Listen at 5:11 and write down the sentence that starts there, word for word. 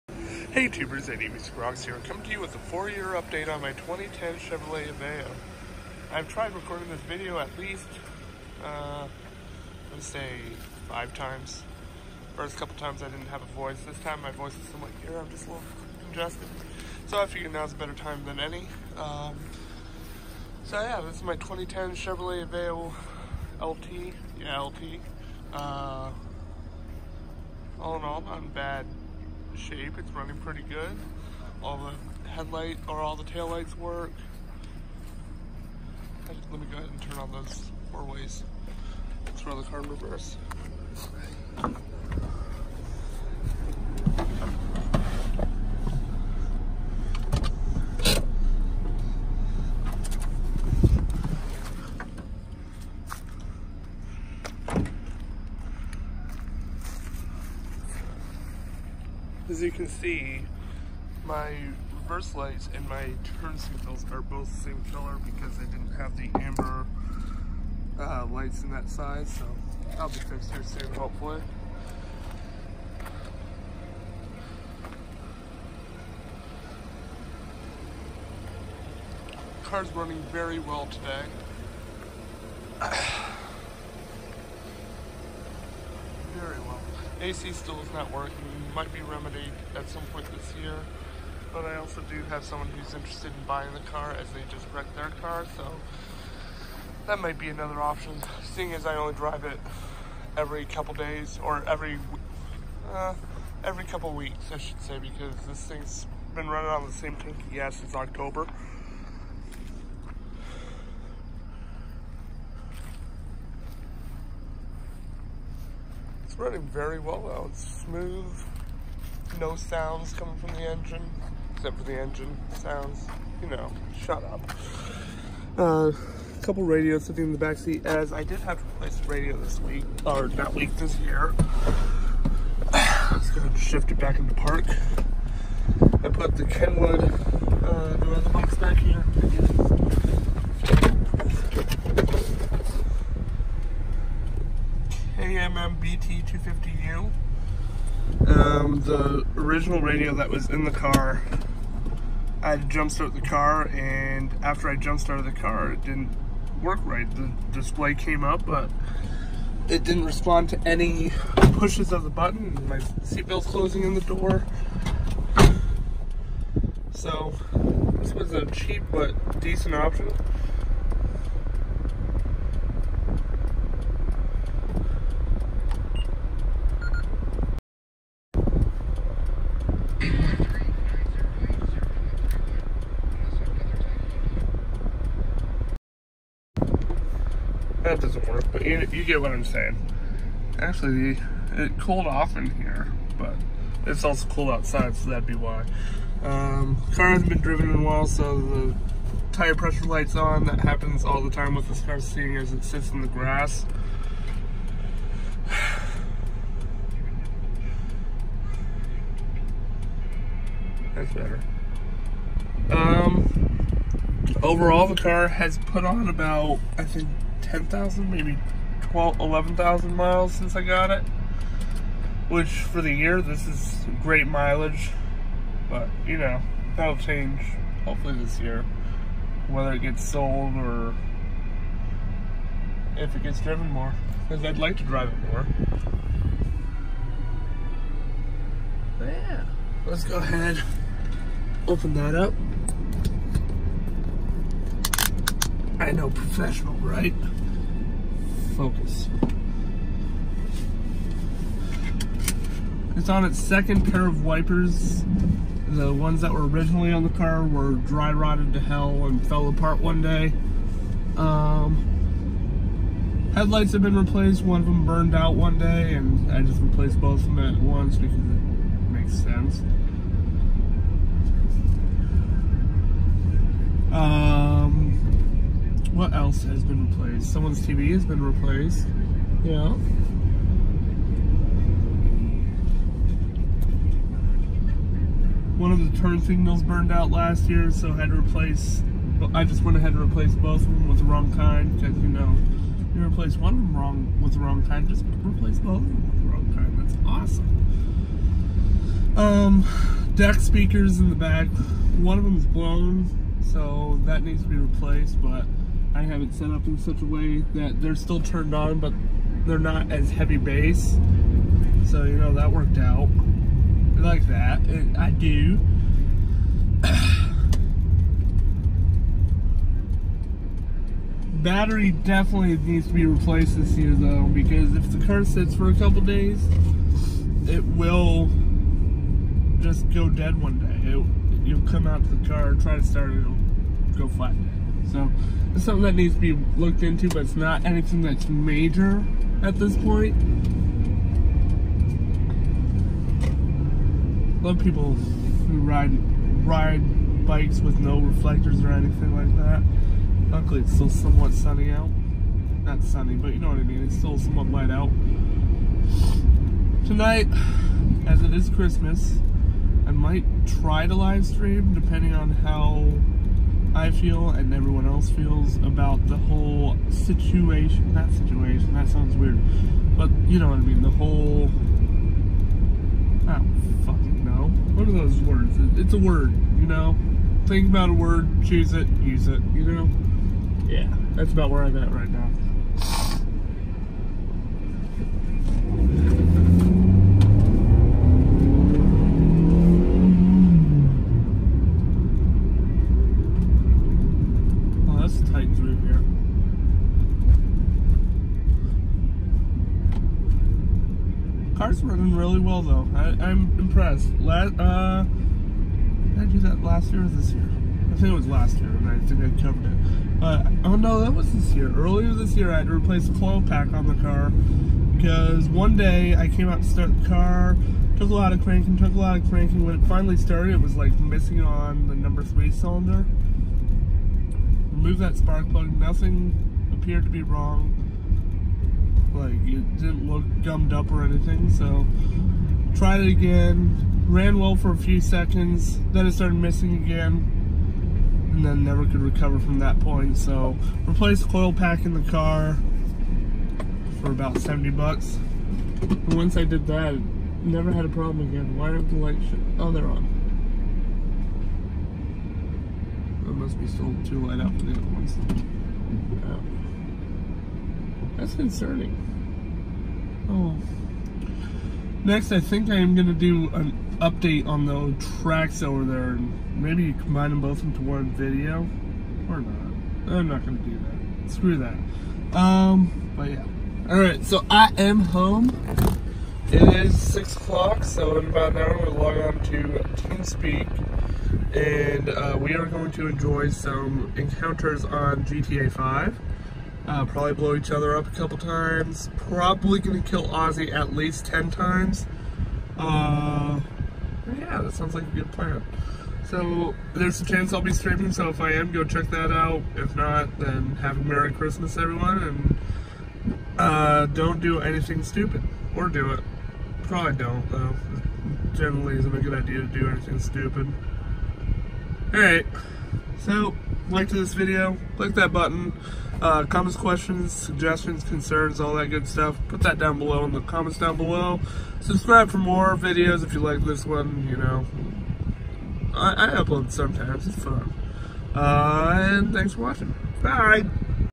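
So, you know, that worked out.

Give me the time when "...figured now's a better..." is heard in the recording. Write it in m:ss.
0:17.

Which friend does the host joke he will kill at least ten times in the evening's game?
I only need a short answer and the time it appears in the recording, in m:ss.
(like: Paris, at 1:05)
Ozzy, at 8:10.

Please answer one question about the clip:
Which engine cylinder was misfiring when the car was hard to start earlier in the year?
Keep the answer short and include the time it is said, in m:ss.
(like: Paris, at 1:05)
number 3, at 7:01.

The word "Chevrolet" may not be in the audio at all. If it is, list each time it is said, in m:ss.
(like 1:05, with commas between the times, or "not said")
0:04, 0:21.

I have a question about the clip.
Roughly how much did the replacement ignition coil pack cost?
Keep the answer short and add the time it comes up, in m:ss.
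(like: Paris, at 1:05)
about $70, at 7:24.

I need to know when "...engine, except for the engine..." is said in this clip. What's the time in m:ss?
2:00.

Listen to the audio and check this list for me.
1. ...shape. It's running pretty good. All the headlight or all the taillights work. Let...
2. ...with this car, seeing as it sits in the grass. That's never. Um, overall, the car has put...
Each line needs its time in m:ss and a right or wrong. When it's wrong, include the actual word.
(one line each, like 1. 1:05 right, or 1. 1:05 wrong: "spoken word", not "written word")
1. 0:29 right
2. 3:21 wrong: "better", not "never".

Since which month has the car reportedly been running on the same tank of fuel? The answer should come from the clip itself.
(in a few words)
October.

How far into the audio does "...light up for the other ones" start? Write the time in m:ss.
7:34.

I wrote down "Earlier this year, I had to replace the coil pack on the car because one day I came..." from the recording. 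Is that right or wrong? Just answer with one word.
right.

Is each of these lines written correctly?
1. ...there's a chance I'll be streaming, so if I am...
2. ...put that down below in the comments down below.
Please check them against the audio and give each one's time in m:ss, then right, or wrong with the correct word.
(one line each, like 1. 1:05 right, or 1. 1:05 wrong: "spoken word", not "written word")
1. 8:16 right
2. 8:39 right.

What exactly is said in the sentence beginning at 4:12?
It's on its second pair of wipers.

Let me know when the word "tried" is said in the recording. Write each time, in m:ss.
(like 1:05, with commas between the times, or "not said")
0:06, 7:12.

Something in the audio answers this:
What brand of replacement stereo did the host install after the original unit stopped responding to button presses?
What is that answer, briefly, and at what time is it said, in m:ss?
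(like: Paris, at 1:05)
Kenwood, at 2:16.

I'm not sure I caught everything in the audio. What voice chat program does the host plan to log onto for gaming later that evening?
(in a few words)
TeamSpeak.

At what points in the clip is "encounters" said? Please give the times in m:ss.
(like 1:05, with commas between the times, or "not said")
8:04.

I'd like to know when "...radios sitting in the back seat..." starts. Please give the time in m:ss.
2:06.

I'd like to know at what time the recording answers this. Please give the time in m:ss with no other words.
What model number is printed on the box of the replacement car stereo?
2:25.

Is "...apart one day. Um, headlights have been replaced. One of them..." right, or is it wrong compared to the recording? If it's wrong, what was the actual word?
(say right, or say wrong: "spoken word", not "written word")
right.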